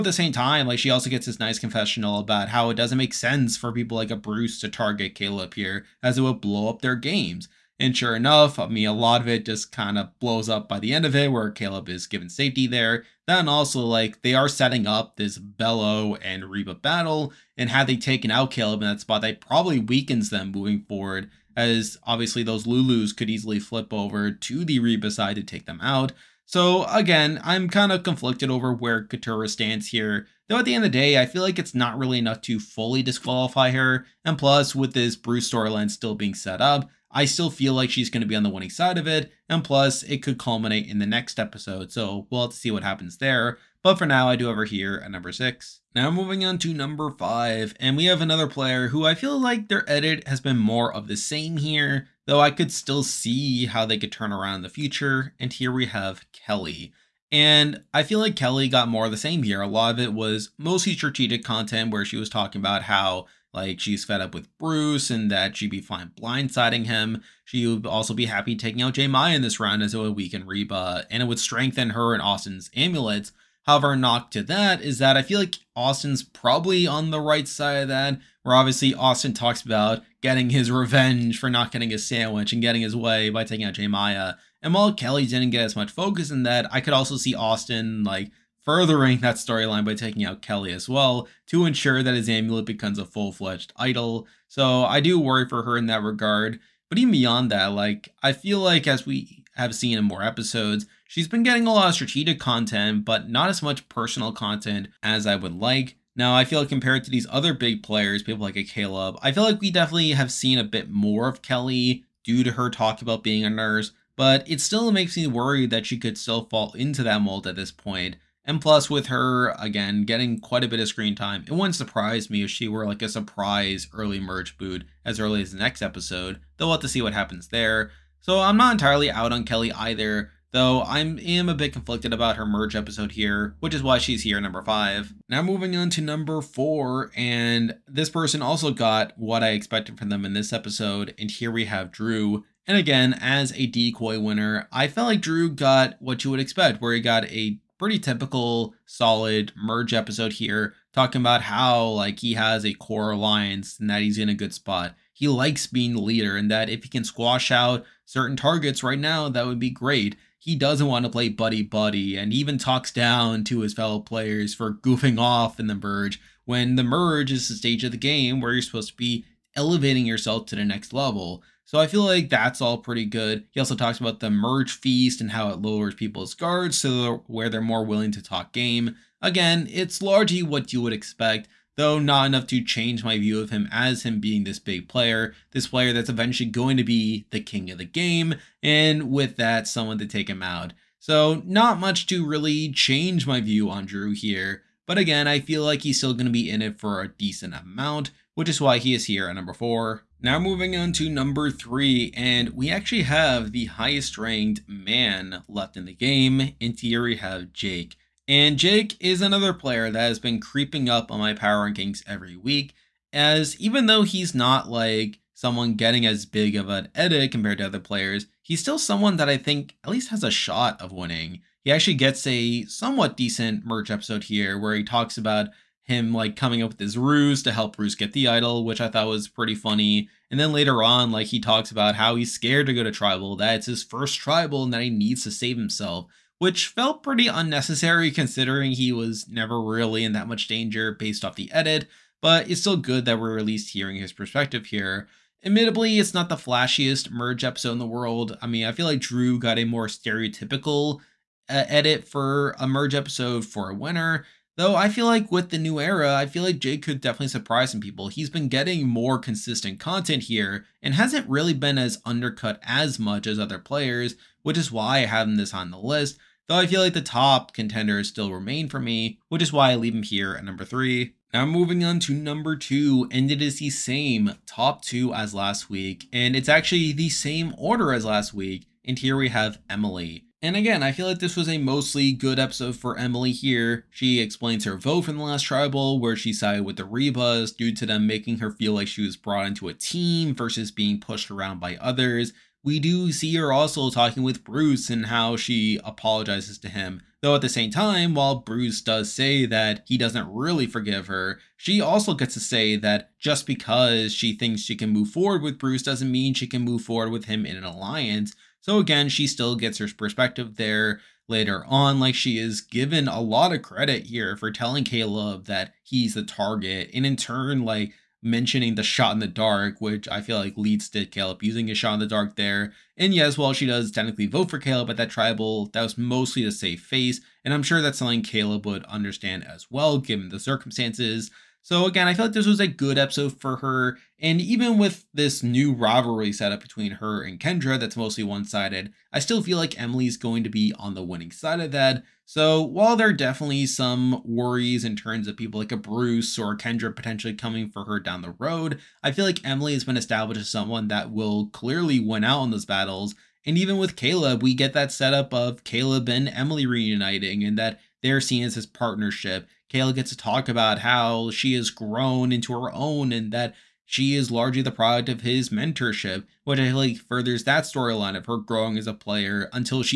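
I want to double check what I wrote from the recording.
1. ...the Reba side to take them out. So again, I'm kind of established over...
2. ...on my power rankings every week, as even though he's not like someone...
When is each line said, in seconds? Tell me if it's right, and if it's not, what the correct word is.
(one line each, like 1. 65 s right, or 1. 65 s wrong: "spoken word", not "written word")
1. 24 s wrong: "conflicted", not "established"
2. 211 s right.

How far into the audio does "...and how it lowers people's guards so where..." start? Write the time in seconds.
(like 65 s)
175 s.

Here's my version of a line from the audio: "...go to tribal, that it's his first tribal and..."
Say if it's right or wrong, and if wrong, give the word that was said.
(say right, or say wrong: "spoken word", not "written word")
right.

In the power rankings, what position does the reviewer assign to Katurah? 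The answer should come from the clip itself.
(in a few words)
6.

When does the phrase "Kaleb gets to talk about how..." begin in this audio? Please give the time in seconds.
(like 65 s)
359 s.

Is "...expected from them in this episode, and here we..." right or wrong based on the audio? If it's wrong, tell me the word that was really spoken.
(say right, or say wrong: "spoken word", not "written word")
right.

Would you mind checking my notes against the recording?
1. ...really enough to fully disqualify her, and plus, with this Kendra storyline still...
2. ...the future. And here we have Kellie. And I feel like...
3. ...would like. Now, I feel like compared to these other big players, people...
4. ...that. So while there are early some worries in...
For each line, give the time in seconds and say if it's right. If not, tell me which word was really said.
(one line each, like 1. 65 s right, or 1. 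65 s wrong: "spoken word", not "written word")
1. 31 s wrong: "Bruce", not "Kendra"
2. 54 s right
3. 105 s right
4. 341 s wrong: "definitely", not "early".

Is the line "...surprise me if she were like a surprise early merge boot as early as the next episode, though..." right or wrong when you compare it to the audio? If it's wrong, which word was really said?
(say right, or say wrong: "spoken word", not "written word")
right.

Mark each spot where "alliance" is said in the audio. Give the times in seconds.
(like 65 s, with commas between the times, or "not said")
153 s, 307 s.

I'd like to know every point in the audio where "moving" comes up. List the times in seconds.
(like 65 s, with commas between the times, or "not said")
20 s, 46 s, 135 s, 200 s, 271 s.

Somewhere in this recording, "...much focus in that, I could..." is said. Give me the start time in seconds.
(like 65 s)
85 s.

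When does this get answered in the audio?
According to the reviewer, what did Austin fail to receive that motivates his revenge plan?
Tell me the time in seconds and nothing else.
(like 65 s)
81 s.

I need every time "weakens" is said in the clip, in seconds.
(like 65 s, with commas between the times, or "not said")
19 s, 70 s.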